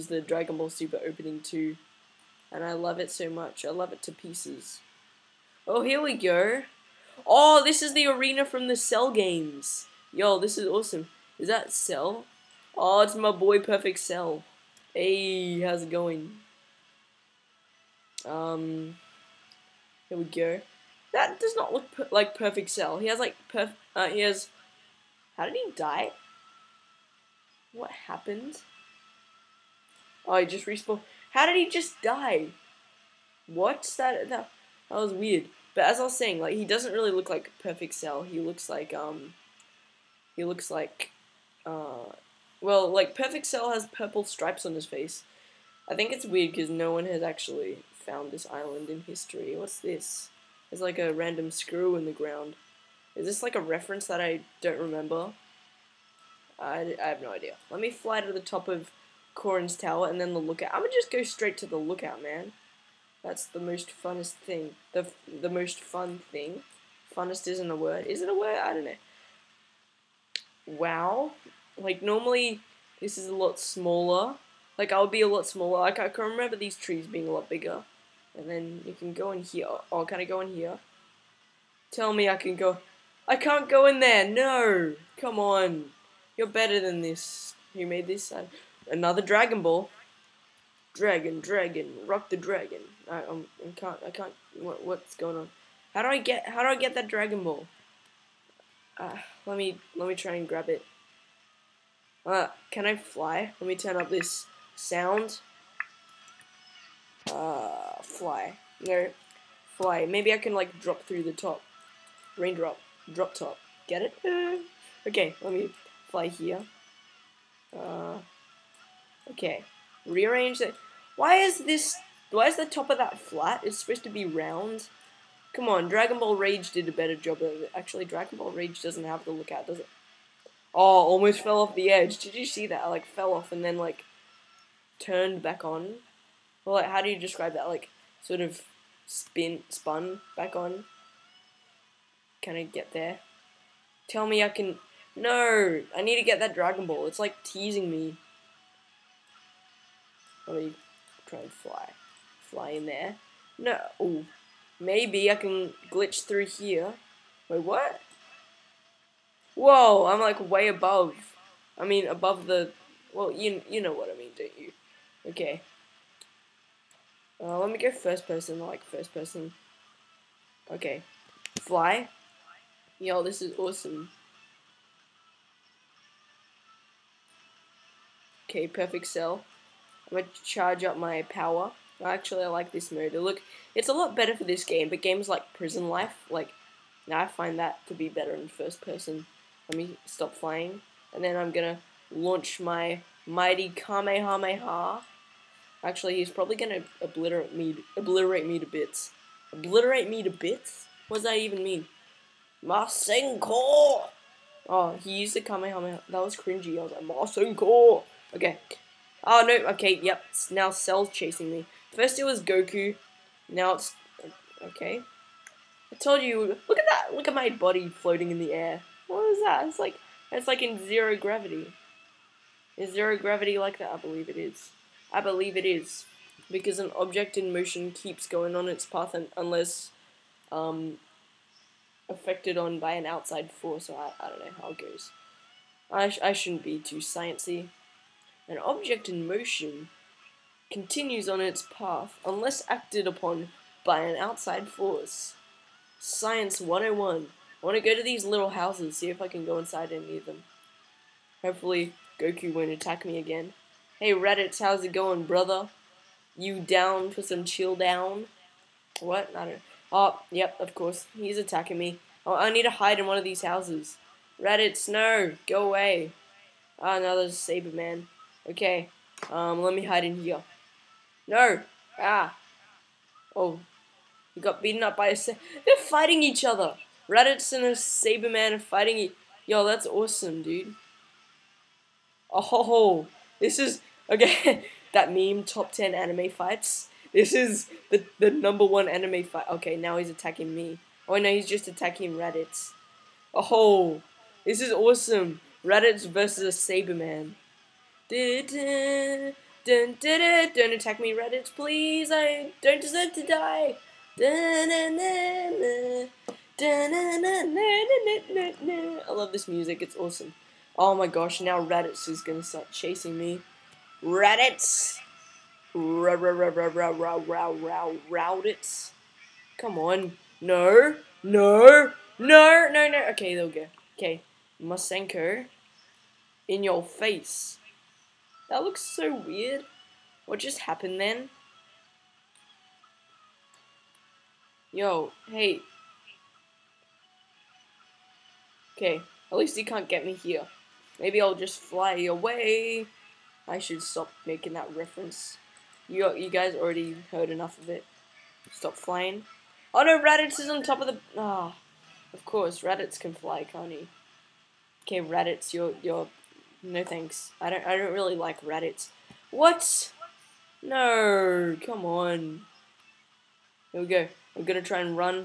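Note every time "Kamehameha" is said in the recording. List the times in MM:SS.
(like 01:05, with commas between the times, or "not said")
03:13, 03:25.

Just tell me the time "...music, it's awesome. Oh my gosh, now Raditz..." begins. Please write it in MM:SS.
05:09.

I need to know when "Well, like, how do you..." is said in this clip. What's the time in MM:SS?
02:16.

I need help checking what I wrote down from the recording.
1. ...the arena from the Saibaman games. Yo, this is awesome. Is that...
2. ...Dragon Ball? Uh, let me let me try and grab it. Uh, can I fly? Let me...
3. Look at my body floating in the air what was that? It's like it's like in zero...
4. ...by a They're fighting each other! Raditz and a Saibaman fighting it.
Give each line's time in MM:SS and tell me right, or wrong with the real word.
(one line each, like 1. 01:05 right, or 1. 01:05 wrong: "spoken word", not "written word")
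1. 00:07 wrong: "Cell", not "Saibaman"
2. 01:37 right
3. 03:37 right
4. 04:34 right.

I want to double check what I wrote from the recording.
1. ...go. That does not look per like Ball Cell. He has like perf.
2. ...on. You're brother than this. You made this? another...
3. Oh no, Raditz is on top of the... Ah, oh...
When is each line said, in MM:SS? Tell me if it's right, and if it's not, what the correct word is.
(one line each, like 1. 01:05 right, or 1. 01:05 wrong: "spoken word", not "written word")
1. 00:20 wrong: "Perfect", not "Ball"
2. 01:25 wrong: "better", not "brother"
3. 05:49 right.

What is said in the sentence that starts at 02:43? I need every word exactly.
Well, you you know what I mean, don't you?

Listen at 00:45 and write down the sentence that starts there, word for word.
I think it's weird because no one has actually found this island in history.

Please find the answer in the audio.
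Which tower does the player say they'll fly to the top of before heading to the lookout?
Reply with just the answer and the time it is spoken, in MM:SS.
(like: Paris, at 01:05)
Korin's tower, at 00:59.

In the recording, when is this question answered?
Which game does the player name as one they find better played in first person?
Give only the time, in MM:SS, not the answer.
03:05.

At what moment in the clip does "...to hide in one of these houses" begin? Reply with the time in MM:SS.
04:22.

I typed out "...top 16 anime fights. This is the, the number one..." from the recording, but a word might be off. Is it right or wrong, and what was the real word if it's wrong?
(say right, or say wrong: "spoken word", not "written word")
wrong: "10", not "16".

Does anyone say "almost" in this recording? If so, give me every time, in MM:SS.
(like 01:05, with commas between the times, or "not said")
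02:11.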